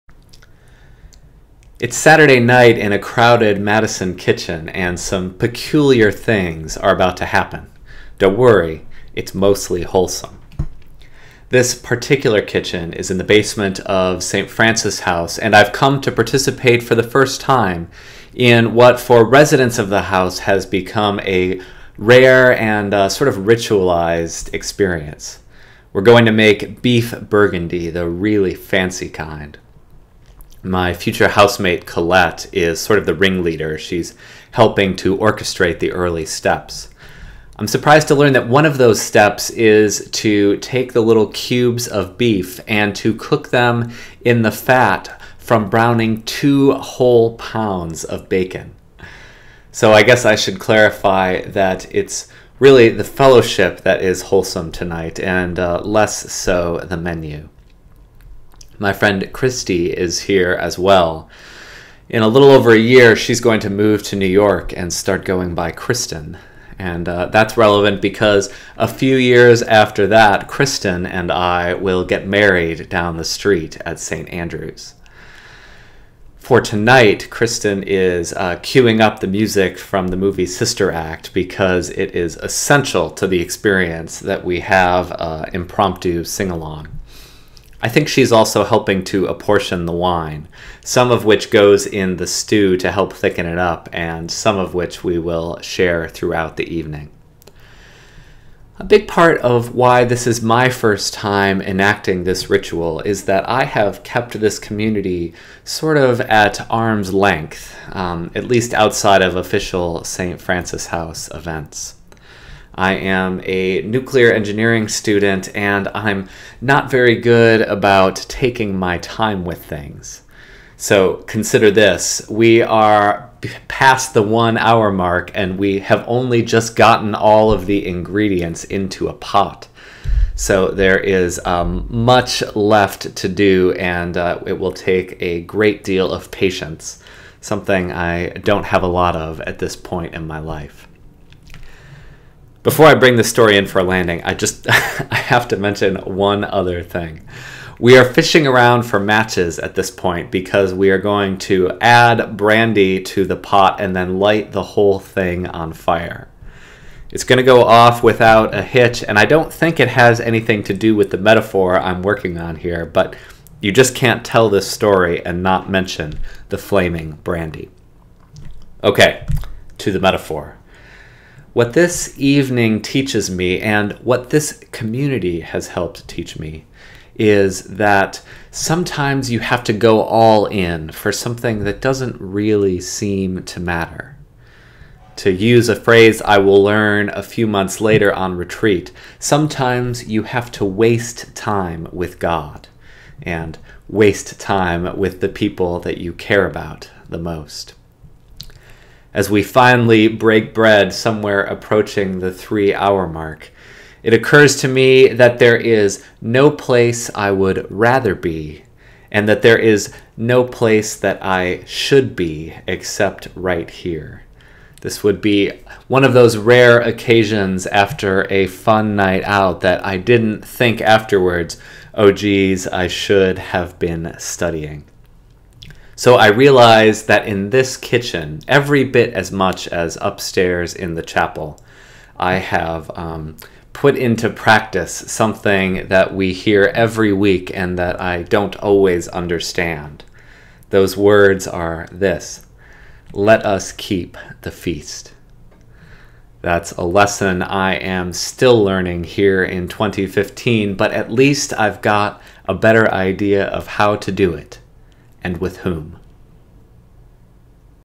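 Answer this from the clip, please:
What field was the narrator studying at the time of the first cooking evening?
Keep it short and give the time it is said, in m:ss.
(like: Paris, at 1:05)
Nuclear engineering, at 1:53.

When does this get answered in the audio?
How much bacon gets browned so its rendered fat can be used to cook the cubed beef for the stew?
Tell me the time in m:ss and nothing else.
0:46.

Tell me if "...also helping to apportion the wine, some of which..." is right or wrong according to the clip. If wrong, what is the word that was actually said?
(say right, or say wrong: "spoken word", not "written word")
right.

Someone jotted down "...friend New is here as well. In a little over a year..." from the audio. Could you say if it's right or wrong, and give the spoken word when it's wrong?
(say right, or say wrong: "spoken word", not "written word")
wrong: "Kristie", not "New".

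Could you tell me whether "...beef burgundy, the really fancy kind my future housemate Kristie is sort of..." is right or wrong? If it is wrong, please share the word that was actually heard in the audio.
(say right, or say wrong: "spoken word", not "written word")
wrong: "Colette", not "Kristie".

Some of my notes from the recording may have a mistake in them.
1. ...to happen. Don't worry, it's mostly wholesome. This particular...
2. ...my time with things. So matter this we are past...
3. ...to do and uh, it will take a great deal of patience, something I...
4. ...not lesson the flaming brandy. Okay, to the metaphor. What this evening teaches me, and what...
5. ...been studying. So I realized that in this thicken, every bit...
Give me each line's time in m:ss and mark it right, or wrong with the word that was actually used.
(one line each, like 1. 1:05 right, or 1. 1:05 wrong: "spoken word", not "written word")
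1. 0:07 right
2. 1:58 wrong: "consider", not "matter"
3. 2:13 right
4. 2:45 wrong: "mention", not "lesson"
5. 3:43 wrong: "kitchen", not "thicken".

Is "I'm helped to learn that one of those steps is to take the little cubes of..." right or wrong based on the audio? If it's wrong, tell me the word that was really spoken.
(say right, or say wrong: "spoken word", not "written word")
wrong: "surprised", not "helped".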